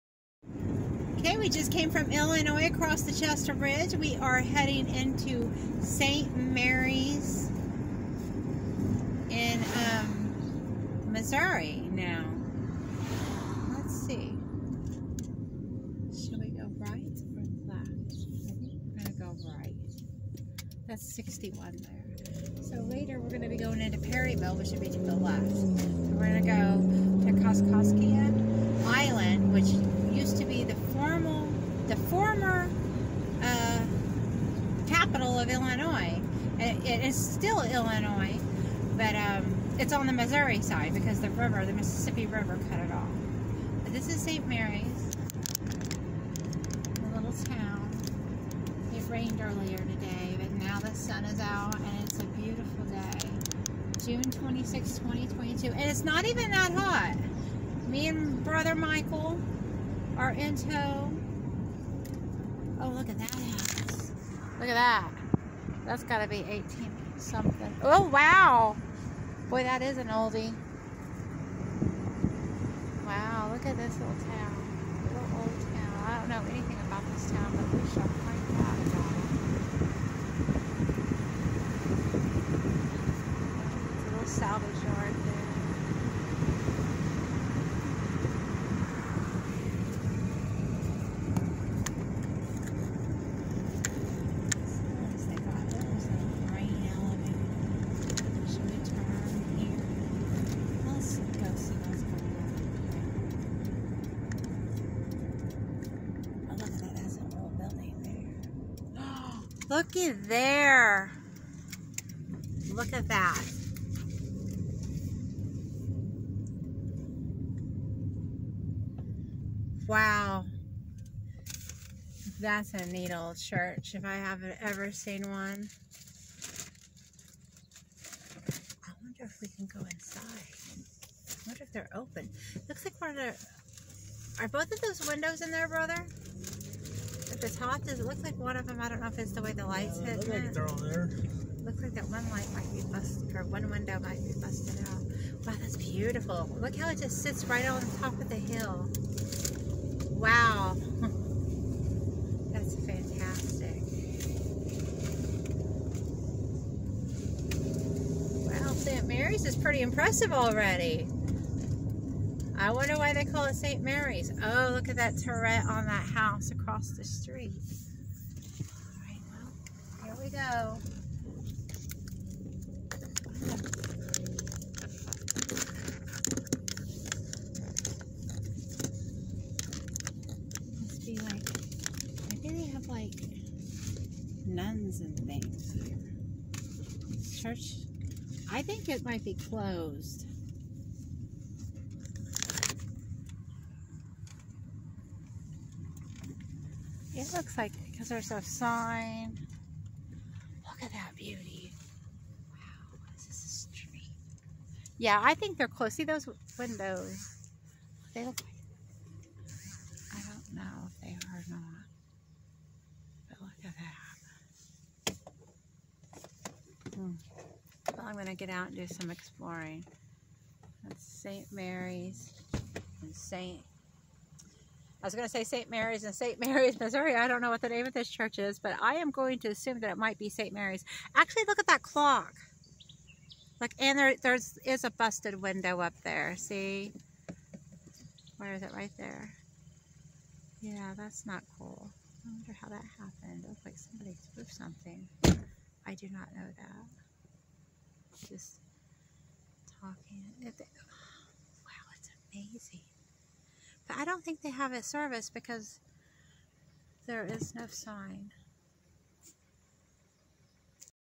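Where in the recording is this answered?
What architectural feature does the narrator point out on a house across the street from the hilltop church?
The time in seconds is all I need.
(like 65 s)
165 s.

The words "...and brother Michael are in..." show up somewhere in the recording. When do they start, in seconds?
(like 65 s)
58 s.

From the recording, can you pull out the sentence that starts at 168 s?
All right, well, here we go.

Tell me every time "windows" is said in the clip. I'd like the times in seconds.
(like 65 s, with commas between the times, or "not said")
135 s, 143 s, 206 s, 235 s.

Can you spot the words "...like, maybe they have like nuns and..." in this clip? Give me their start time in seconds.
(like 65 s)
181 s.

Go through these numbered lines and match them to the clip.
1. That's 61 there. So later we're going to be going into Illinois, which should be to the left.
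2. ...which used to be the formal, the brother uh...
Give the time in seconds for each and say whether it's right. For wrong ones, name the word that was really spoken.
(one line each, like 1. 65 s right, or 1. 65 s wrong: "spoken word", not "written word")
1. 20 s wrong: "Perryville", not "Illinois"
2. 29 s wrong: "former", not "brother".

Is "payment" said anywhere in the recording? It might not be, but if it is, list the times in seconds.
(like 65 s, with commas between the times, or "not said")
not said.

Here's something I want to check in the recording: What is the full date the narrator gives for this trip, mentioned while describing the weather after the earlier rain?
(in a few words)
June 26, 2022.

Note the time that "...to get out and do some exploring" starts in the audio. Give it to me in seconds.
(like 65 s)
218 s.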